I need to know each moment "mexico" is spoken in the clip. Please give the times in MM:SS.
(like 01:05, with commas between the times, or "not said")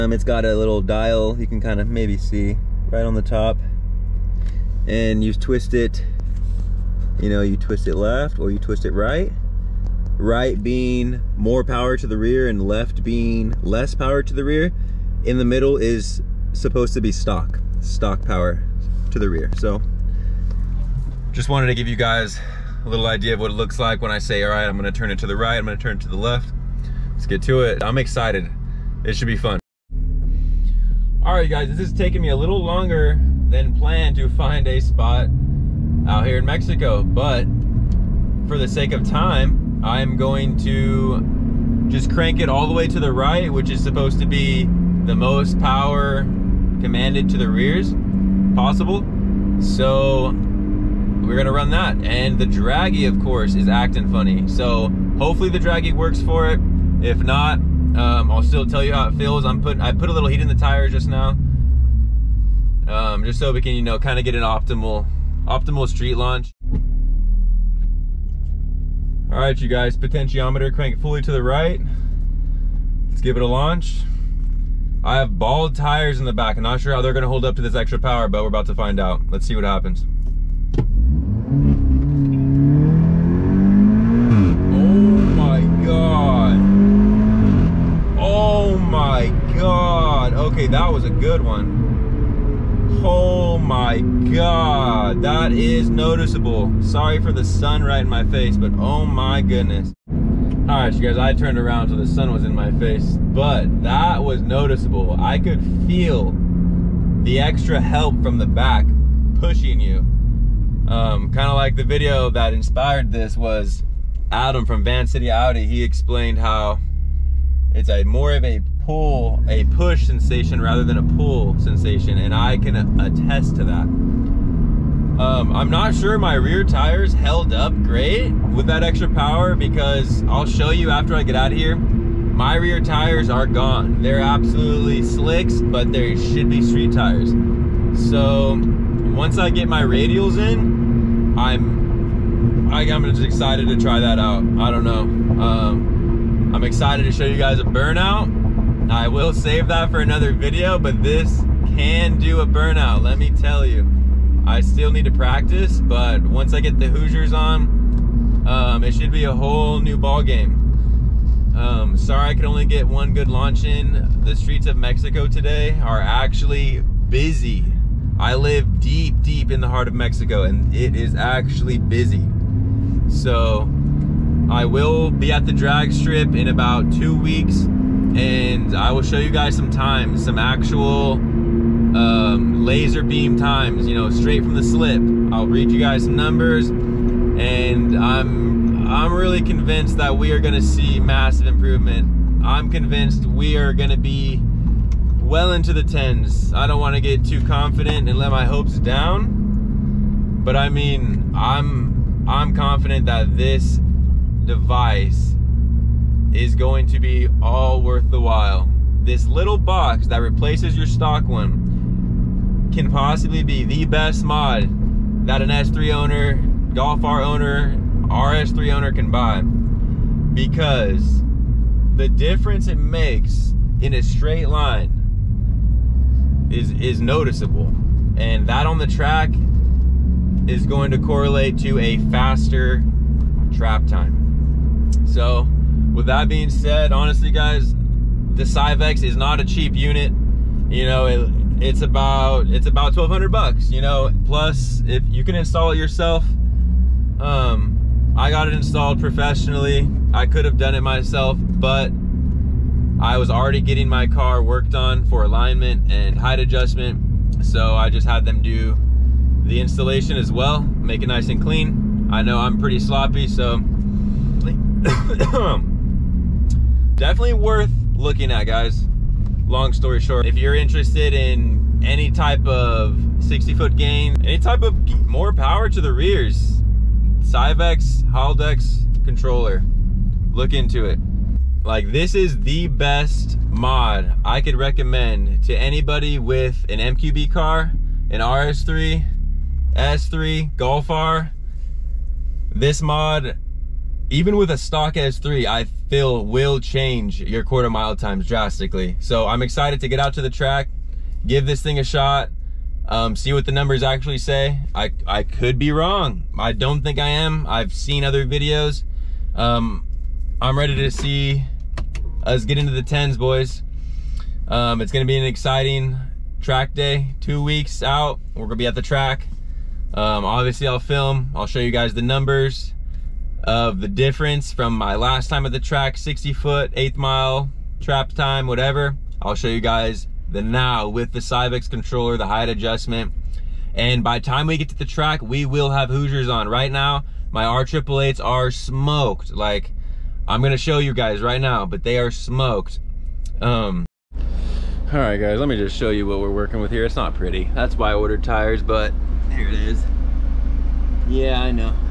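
00:36, 02:44, 02:49.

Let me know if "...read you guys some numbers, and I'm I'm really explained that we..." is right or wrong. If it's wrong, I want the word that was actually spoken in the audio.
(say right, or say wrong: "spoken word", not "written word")
wrong: "convinced", not "explained".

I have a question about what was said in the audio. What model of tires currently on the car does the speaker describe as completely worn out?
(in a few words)
R888s.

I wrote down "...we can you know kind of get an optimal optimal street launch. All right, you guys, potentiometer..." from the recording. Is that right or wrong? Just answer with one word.
right.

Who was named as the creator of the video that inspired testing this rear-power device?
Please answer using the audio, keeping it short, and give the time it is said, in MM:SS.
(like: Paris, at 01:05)
Adam from Van City Audi, at 01:54.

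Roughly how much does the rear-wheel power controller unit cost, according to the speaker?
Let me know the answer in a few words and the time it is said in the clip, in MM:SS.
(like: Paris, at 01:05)
$1200, at 04:02.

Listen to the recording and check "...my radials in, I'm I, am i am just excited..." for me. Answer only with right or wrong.
right.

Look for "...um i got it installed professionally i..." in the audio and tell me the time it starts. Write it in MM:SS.
04:07.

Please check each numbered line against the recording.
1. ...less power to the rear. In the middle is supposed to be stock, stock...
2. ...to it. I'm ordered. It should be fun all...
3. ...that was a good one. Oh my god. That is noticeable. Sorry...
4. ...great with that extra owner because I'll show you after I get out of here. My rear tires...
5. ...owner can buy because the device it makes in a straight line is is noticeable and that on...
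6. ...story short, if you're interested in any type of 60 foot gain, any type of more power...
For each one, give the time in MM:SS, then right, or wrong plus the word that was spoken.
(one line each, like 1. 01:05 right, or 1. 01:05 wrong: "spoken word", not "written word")
1. 00:13 right
2. 00:27 wrong: "excited", not "ordered"
3. 01:30 right
4. 02:07 wrong: "power", not "owner"
5. 03:38 wrong: "difference", not "device"
6. 04:29 right.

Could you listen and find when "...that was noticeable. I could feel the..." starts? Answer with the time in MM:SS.
01:43.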